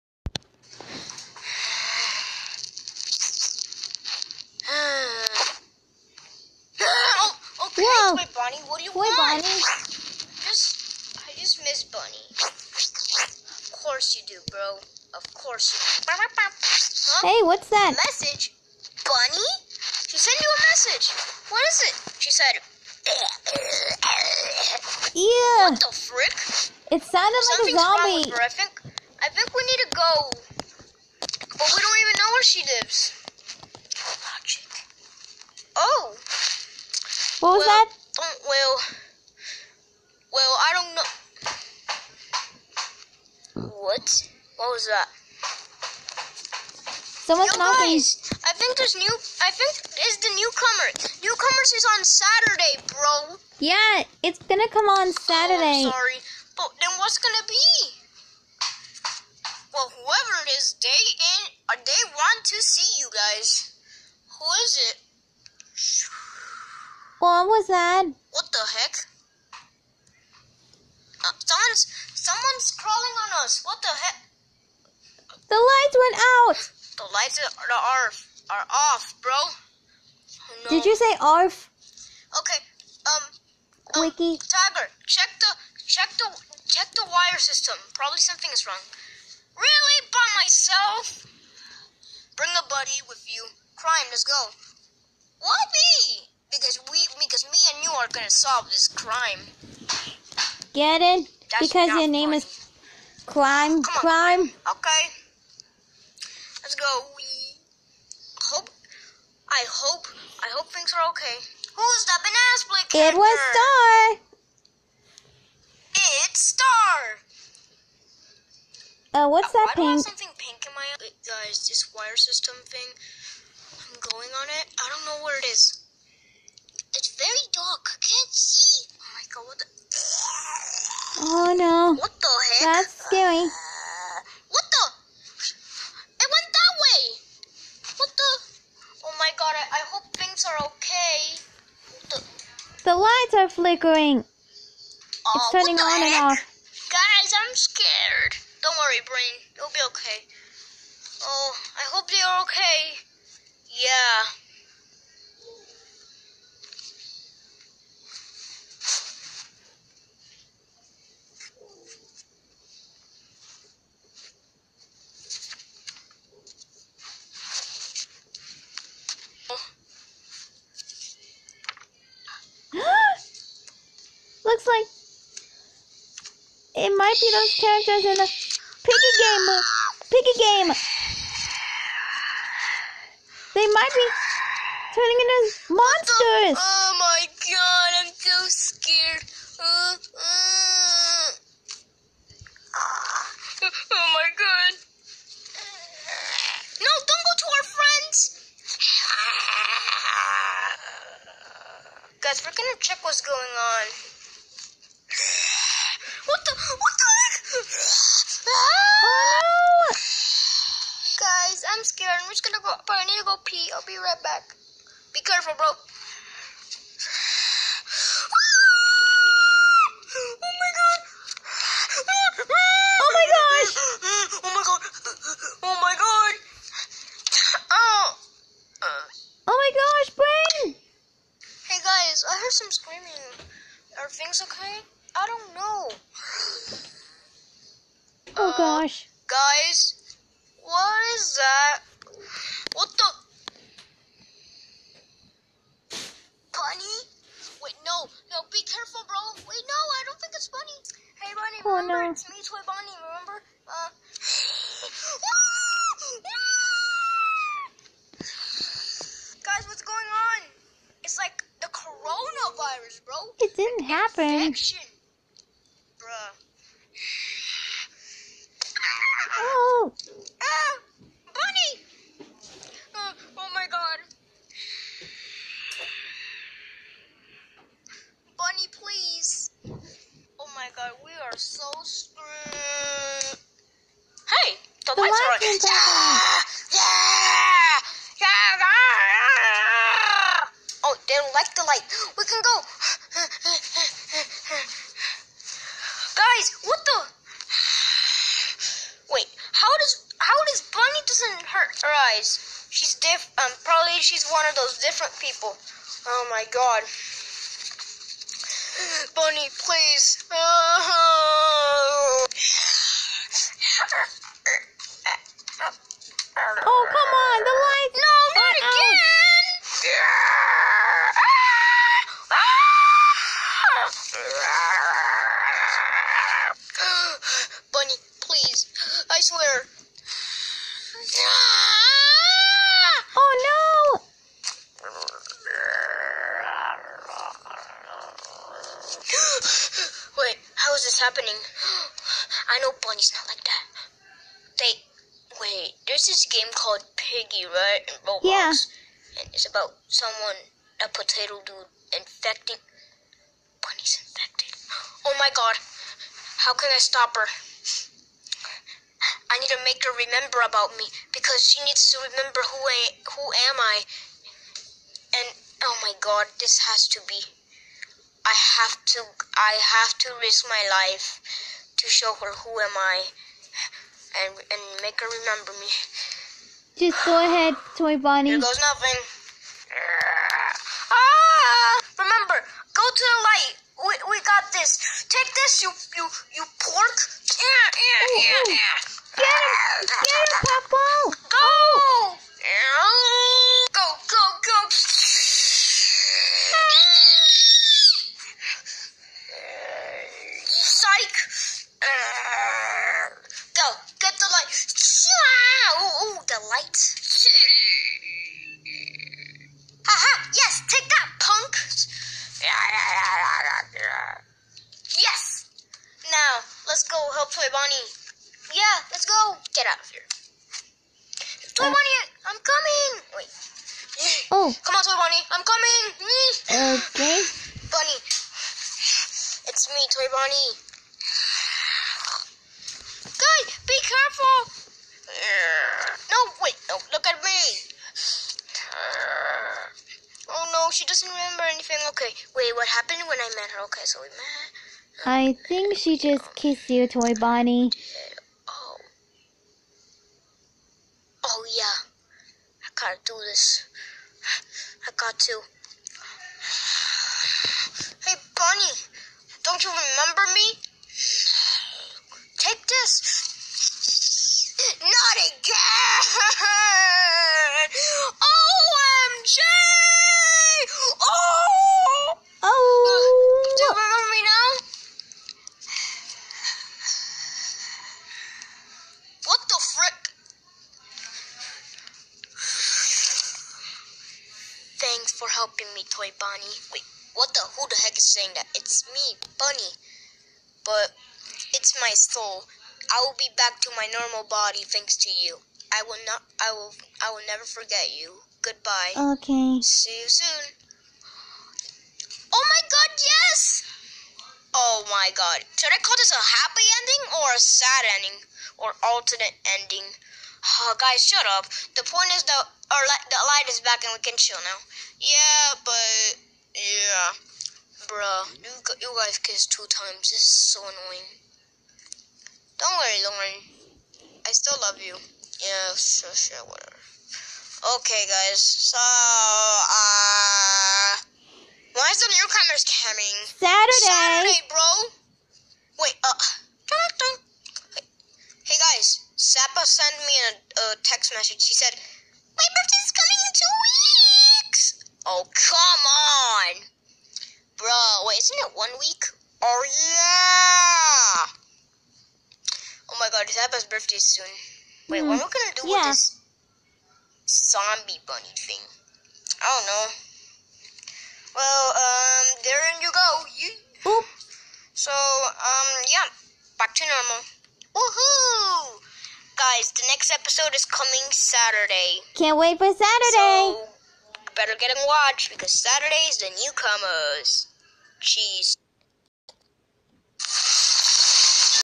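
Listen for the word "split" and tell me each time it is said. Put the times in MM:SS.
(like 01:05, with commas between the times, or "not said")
01:52.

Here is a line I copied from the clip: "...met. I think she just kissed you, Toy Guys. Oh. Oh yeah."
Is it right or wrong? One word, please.
wrong.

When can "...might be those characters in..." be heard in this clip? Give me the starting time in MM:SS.
02:56.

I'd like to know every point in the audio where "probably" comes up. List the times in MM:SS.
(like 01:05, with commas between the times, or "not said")
01:27, 05:03.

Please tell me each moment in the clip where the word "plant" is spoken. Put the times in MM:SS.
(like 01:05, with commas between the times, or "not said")
not said.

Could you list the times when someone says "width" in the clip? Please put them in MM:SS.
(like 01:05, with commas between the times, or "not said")
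not said.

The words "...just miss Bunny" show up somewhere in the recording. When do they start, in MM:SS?
00:11.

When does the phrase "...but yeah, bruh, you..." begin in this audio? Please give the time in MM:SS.
08:35.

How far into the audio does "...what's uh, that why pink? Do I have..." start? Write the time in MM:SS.
01:59.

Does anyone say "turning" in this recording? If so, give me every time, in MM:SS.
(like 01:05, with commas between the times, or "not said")
02:25, 03:04.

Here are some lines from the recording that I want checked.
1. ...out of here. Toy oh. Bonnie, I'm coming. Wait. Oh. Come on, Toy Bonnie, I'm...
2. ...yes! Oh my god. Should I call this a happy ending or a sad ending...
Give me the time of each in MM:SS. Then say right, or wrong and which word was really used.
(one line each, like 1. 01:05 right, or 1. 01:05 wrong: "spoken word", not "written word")
1. 06:59 right
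2. 08:22 right.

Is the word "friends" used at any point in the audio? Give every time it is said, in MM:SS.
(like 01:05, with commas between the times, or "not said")
03:17.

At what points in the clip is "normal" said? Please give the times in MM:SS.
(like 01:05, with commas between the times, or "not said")
08:13, 09:26.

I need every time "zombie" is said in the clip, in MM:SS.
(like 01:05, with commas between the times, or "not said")
00:27, 09:17.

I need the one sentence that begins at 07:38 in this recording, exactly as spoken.
Hey, Bonnie, don't you remember me?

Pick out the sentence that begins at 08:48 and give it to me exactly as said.
So, uh, why is the newcomers coming?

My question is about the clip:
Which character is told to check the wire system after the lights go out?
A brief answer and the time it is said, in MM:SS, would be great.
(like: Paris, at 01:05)
Tiger, at 01:24.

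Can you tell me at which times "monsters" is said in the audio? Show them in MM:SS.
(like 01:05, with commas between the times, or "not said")
03:05.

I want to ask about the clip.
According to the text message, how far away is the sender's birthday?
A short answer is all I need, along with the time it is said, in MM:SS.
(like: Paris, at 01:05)
2 weeks, at 09:03.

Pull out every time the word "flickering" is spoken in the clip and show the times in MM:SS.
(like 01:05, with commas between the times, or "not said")
02:23.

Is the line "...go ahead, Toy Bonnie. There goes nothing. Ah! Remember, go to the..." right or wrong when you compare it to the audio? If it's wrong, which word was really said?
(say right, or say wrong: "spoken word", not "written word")
right.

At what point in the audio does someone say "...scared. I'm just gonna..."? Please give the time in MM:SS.
03:31.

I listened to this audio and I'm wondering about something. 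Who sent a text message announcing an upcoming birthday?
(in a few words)
Sappa.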